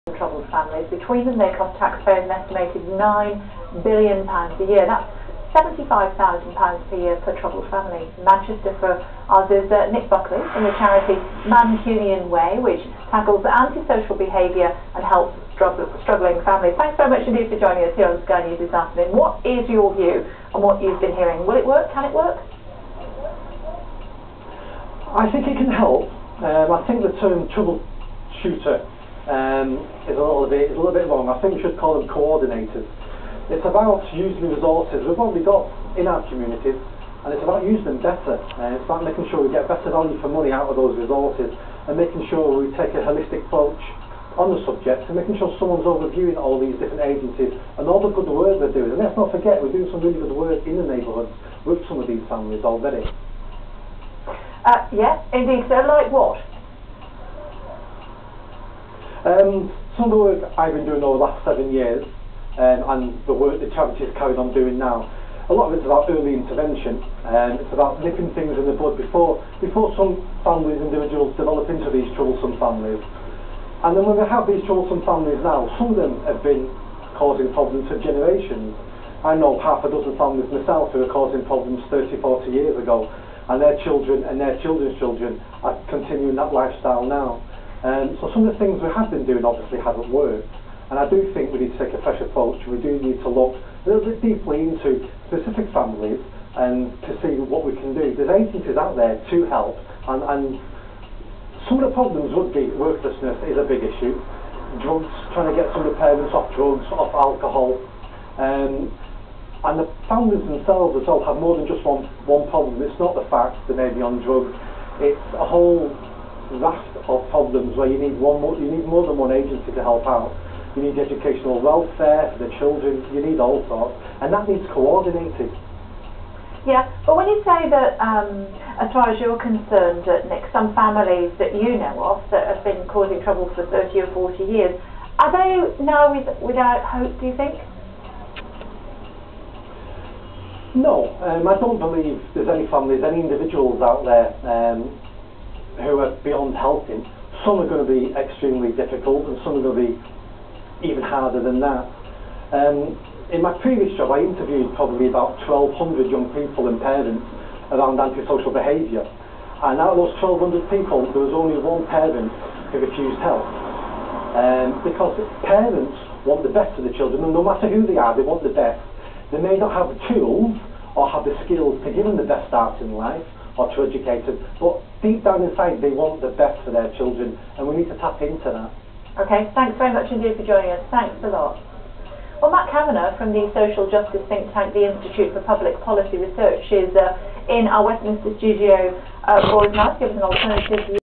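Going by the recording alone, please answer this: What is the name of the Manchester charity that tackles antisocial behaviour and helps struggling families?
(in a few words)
Mancunian Way.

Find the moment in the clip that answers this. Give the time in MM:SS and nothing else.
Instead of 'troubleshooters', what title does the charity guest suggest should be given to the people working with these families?
00:32.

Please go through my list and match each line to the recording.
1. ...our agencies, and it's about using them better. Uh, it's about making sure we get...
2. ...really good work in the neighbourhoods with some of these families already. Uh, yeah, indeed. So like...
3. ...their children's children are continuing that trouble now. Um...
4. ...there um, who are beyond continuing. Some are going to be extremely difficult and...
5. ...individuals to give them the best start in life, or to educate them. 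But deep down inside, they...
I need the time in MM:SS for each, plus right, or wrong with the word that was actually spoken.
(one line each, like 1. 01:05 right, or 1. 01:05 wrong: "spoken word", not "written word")
1. 00:36 wrong: "communities", not "agencies"
2. 00:50 right
3. 01:24 wrong: "lifestyle", not "trouble"
4. 02:24 wrong: "helping", not "continuing"
5. 02:51 wrong: "skills", not "individuals".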